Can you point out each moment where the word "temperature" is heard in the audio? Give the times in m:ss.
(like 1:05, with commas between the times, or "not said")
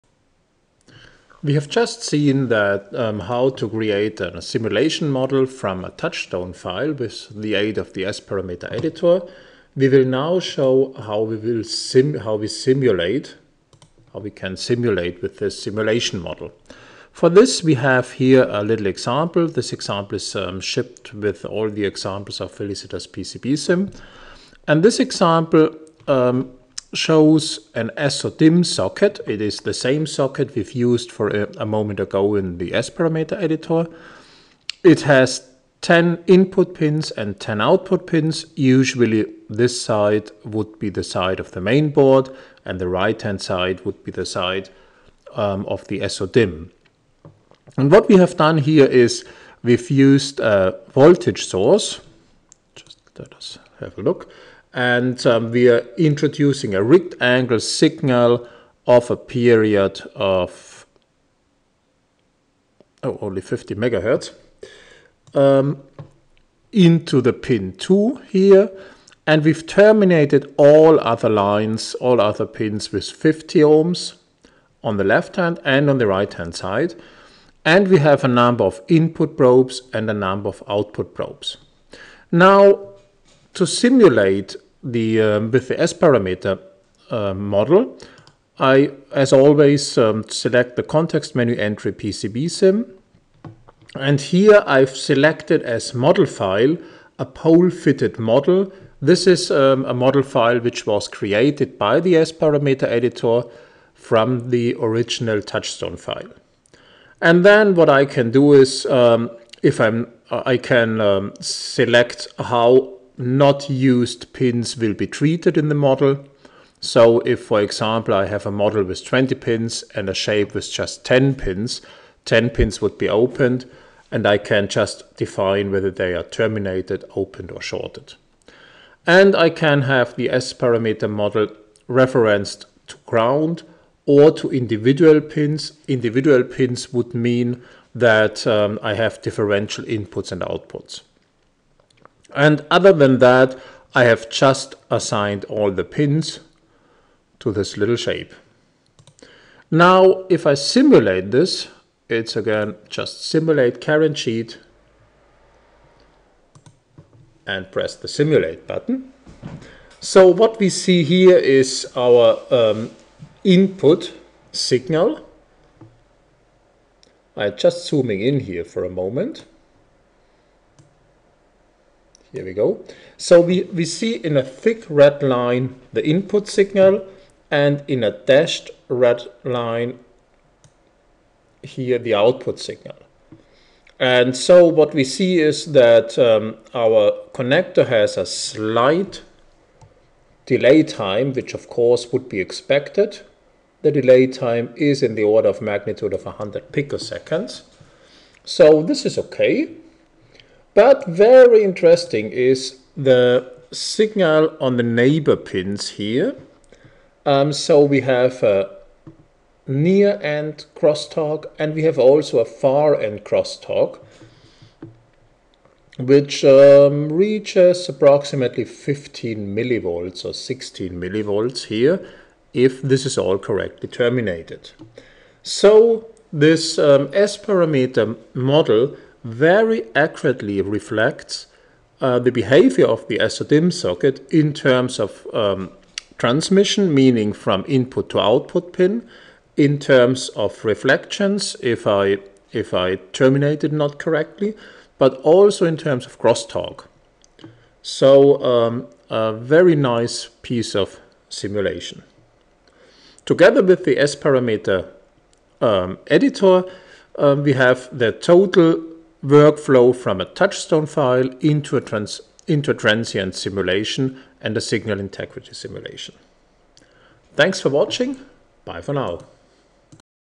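not said.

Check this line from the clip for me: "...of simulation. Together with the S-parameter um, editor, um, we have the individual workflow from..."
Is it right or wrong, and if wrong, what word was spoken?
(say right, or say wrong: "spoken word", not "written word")
wrong: "total", not "individual".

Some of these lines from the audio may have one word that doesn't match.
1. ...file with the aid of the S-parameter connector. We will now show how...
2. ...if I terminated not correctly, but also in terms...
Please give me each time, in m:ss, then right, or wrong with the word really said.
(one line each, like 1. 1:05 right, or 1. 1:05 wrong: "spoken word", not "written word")
1. 0:06 wrong: "editor", not "connector"
2. 4:02 right.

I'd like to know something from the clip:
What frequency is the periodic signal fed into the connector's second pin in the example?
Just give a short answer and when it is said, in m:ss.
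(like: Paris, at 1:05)
50 megahertz, at 1:03.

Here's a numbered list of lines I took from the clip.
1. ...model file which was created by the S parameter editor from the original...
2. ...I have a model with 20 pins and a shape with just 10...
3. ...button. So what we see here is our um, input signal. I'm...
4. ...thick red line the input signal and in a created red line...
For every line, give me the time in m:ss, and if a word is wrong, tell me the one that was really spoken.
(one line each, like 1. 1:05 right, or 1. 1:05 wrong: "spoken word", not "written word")
1. 1:39 right
2. 1:58 right
3. 2:38 right
4. 2:54 wrong: "dashed", not "created".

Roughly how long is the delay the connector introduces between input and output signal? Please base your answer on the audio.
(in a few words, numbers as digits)
100 picoseconds.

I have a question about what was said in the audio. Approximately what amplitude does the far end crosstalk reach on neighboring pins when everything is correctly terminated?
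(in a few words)
15 millivolts.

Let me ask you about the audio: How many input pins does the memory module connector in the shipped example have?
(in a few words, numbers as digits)
10.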